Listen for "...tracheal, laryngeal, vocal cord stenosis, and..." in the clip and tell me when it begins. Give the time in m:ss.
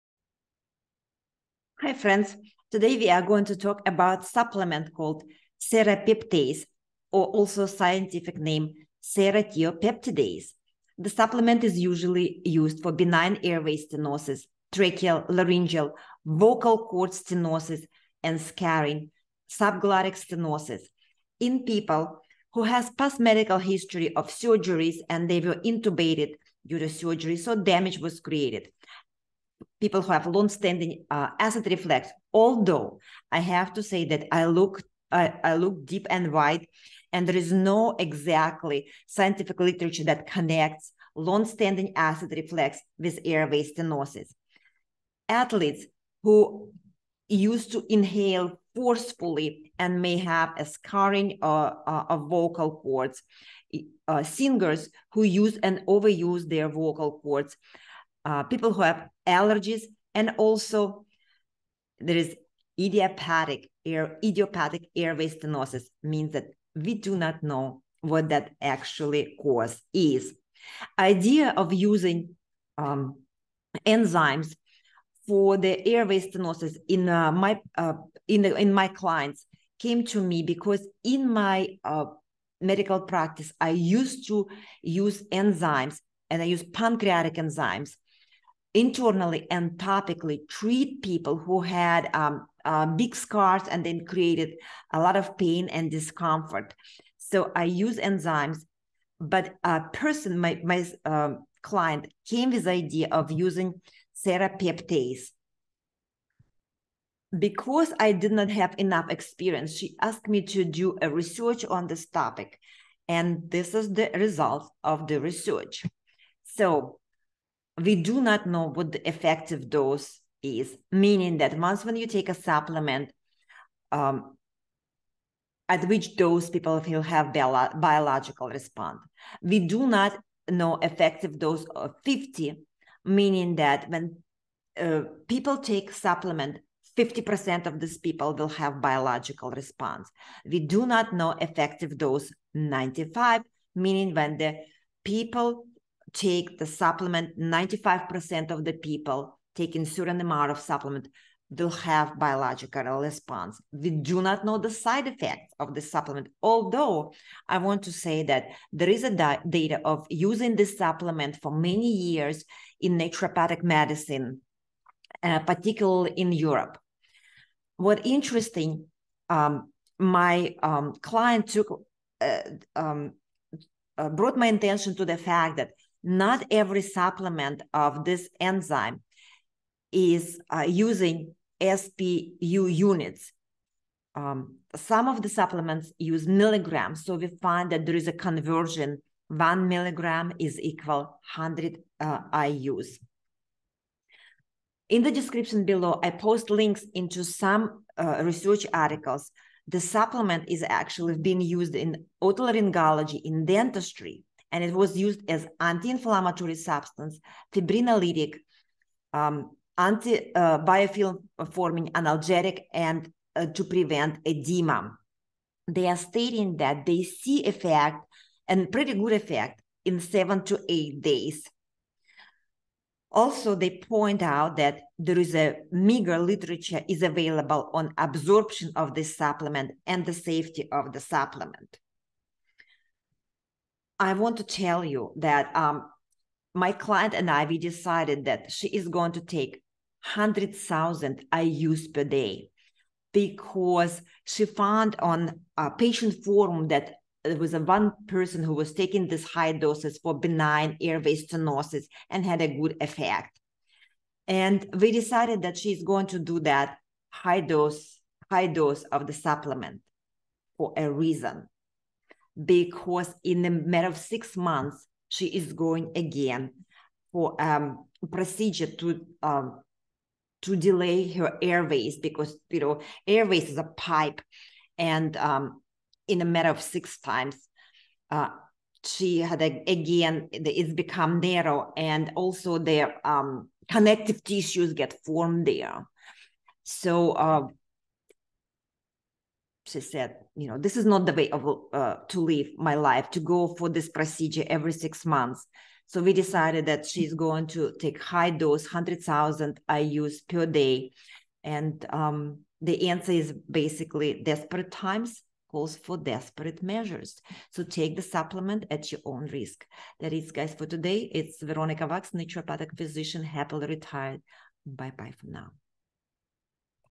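0:14.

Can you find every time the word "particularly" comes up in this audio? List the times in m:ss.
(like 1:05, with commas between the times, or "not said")
2:45.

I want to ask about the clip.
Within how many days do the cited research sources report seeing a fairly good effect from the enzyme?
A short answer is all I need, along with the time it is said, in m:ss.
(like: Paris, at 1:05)
7 to 8 days, at 3:40.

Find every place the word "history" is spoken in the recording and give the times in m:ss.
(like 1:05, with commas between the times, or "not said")
0:23.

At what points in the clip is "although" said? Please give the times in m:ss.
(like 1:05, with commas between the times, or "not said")
0:32, 2:36.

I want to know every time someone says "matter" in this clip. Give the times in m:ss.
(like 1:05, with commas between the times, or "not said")
4:23, 4:36.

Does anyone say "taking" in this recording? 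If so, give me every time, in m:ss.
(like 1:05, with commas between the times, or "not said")
2:29, 4:08.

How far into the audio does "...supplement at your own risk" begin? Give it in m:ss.
5:08.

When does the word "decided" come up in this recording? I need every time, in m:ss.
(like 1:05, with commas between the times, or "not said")
3:57, 4:14, 4:56.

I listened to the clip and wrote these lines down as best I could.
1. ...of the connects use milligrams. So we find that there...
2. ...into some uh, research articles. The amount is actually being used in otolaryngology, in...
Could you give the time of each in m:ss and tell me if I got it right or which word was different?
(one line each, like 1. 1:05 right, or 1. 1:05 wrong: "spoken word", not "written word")
1. 3:05 wrong: "supplements", not "connects"
2. 3:16 wrong: "supplement", not "amount".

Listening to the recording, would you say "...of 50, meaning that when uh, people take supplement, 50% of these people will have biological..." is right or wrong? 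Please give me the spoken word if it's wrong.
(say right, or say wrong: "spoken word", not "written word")
right.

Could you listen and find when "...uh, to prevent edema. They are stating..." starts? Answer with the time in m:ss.
3:33.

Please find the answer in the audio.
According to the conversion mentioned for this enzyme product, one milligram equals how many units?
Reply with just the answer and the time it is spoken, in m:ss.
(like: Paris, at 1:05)
100 IUs, at 3:11.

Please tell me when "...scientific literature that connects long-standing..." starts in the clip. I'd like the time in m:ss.
0:39.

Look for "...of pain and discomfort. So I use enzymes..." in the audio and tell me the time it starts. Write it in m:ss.
1:35.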